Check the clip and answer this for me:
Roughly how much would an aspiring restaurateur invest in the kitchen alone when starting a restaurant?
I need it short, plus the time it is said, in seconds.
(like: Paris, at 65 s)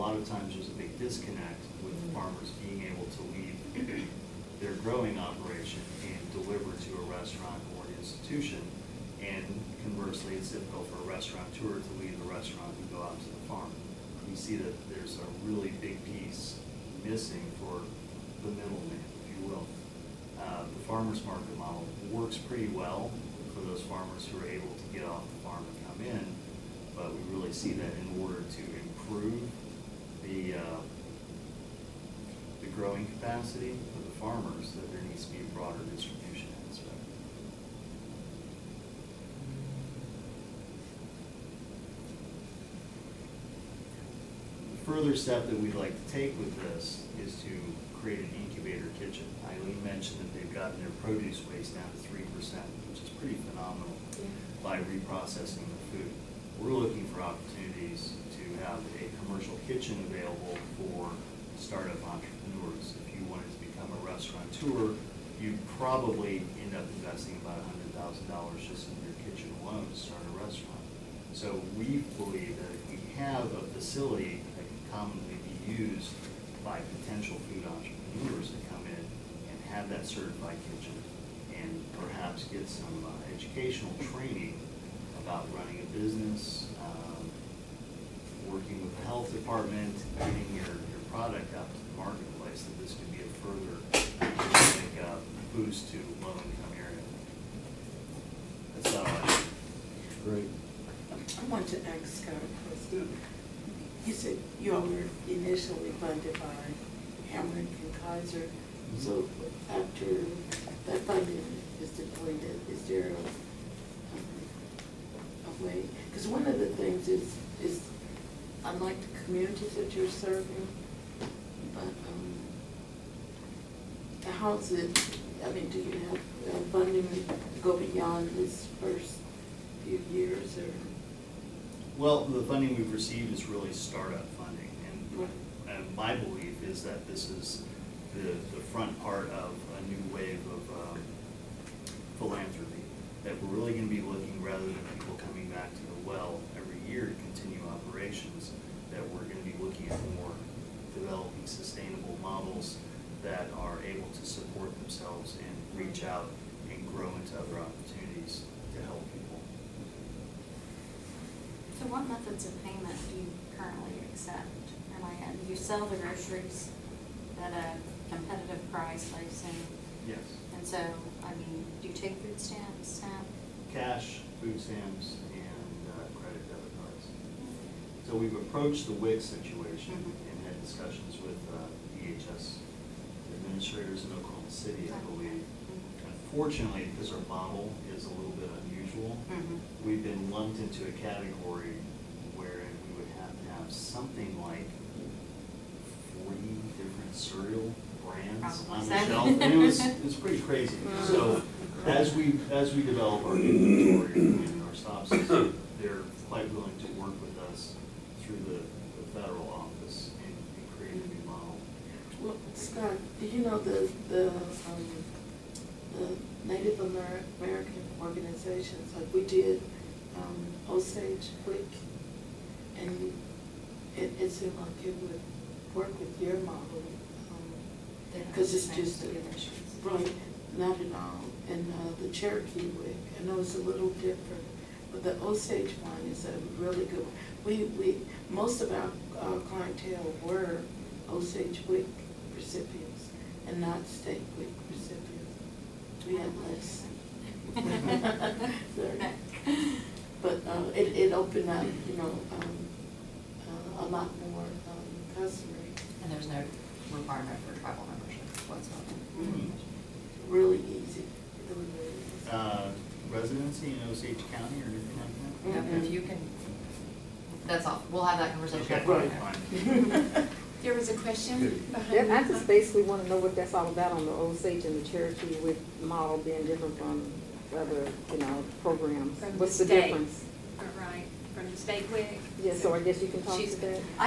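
$100,000, at 67 s.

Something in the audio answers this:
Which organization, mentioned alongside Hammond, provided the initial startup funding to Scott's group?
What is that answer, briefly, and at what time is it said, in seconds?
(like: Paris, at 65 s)
Kaiser, at 108 s.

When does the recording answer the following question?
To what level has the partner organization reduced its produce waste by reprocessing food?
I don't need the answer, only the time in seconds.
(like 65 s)
52 s.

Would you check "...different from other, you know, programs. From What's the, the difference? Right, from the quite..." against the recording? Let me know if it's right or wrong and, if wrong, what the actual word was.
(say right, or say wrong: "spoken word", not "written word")
wrong: "state", not "quite".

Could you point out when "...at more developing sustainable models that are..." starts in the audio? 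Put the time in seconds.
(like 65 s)
149 s.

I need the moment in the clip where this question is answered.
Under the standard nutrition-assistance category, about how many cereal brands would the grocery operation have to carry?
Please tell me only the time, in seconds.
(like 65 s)
196 s.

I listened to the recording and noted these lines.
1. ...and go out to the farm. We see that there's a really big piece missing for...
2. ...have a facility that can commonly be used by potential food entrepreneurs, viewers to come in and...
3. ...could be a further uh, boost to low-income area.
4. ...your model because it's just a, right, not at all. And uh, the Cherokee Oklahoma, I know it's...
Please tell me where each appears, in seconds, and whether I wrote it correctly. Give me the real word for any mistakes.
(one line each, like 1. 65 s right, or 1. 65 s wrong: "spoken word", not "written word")
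1. 12 s right
2. 73 s right
3. 92 s right
4. 226 s wrong: "WIC", not "Oklahoma".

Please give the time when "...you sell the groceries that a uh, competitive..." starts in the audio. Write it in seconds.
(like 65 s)
165 s.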